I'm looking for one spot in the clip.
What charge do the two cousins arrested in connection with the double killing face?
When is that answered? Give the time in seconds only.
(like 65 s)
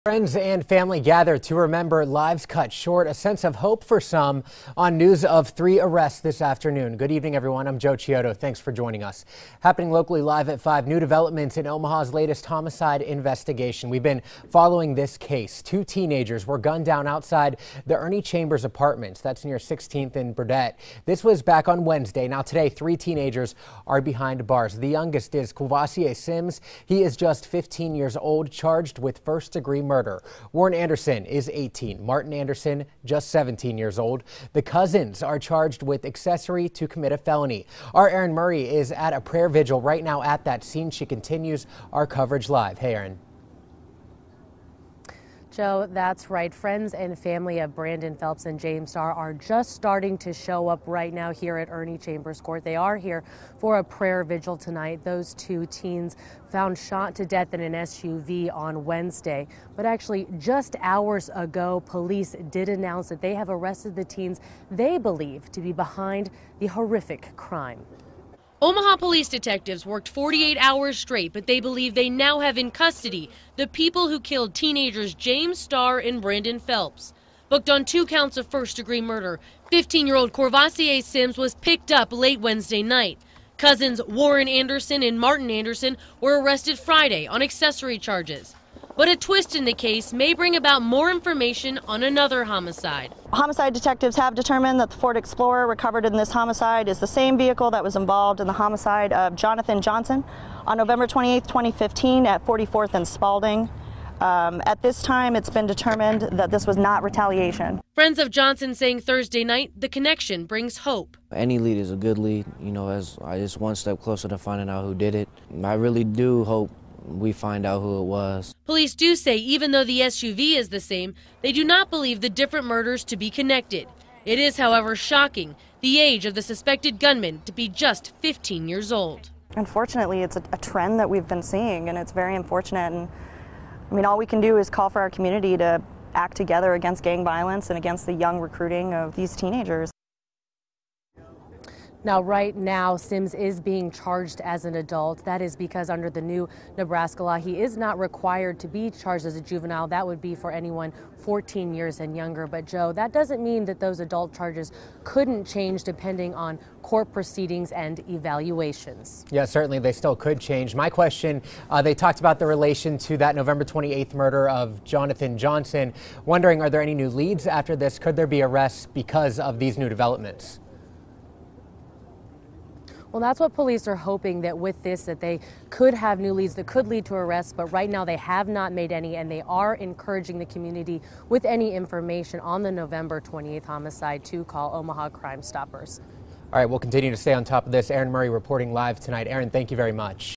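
36 s.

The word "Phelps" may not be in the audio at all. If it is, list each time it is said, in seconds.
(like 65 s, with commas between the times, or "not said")
48 s, 76 s.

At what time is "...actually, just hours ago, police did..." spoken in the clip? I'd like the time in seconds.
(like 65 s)
59 s.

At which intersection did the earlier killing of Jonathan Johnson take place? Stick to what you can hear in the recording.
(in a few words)
44th and Spalding.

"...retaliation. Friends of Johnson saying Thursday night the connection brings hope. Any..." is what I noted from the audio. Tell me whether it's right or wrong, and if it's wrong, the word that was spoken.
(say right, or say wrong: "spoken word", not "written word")
right.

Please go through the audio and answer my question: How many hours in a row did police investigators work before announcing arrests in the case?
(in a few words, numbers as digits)
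48.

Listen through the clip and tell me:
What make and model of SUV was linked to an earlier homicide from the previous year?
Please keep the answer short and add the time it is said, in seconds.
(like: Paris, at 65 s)
Ford Explorer, at 94 s.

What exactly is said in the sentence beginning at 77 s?
Booked on two counts of first-degree murder, 15-year-old Corvassier Sims was picked up late Wednesday night.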